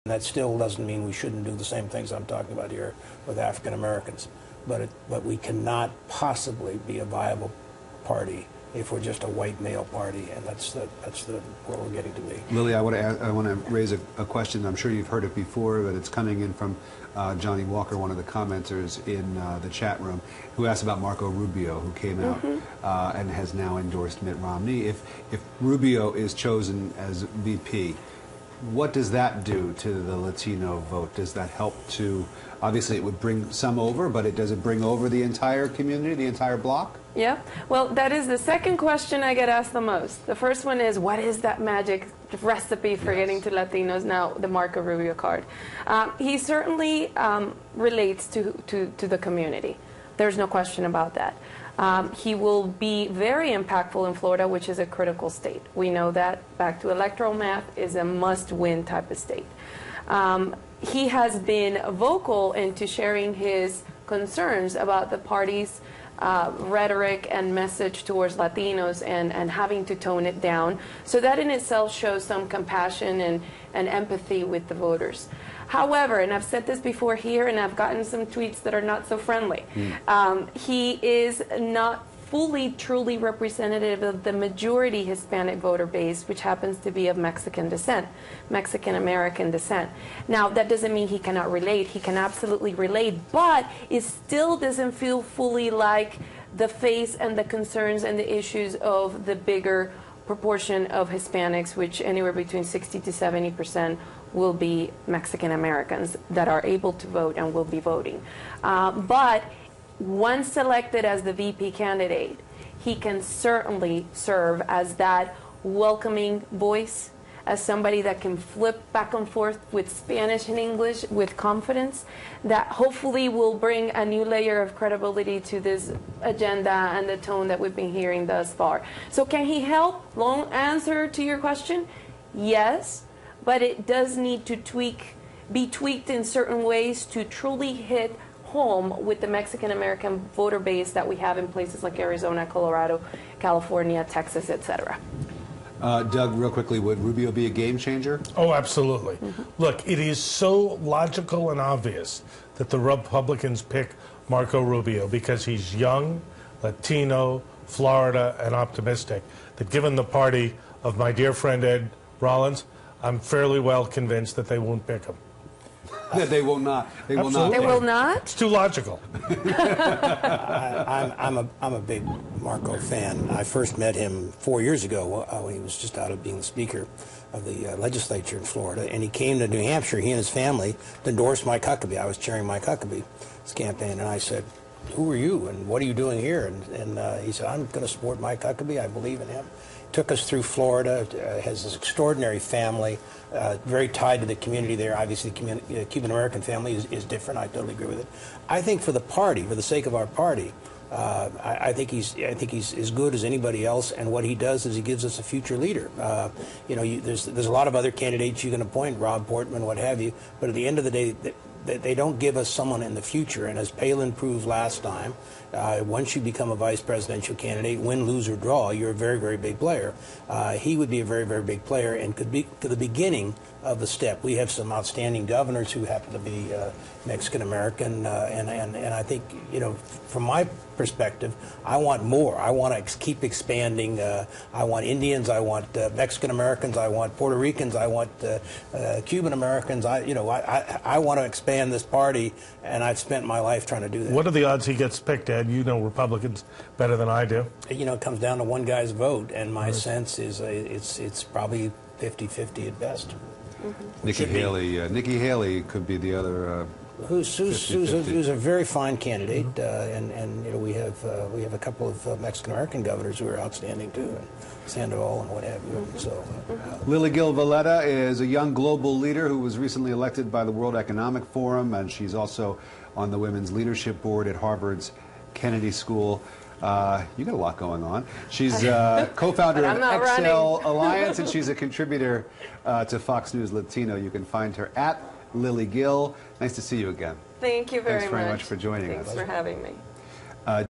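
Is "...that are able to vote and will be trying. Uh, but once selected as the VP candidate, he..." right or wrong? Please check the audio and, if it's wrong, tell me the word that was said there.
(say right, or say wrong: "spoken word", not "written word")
wrong: "voting", not "trying".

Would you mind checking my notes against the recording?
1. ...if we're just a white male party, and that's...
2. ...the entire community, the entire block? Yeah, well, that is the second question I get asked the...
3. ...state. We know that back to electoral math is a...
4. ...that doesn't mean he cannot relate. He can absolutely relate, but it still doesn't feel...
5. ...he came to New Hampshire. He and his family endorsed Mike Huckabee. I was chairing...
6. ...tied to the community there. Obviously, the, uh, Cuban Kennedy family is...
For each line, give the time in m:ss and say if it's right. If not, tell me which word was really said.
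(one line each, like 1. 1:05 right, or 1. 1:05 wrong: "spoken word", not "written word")
1. 0:08 right
2. 0:35 right
3. 0:55 right
4. 1:30 right
5. 2:59 right
6. 3:13 wrong: "American", not "Kennedy".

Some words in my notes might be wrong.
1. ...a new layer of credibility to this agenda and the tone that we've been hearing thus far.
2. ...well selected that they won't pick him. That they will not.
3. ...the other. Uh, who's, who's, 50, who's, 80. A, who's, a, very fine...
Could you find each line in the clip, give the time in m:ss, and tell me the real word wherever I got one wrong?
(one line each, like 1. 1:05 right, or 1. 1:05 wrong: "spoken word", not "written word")
1. 2:03 right
2. 2:43 wrong: "convinced", not "selected"
3. 4:15 wrong: "50", not "80".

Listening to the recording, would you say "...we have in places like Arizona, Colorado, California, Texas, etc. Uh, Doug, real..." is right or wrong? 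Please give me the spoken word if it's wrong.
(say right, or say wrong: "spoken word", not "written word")
right.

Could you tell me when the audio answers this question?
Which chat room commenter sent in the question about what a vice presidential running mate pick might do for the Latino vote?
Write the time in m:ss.
0:17.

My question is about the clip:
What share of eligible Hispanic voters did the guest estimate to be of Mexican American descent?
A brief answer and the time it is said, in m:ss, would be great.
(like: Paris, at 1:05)
60 to 70 percent, at 1:42.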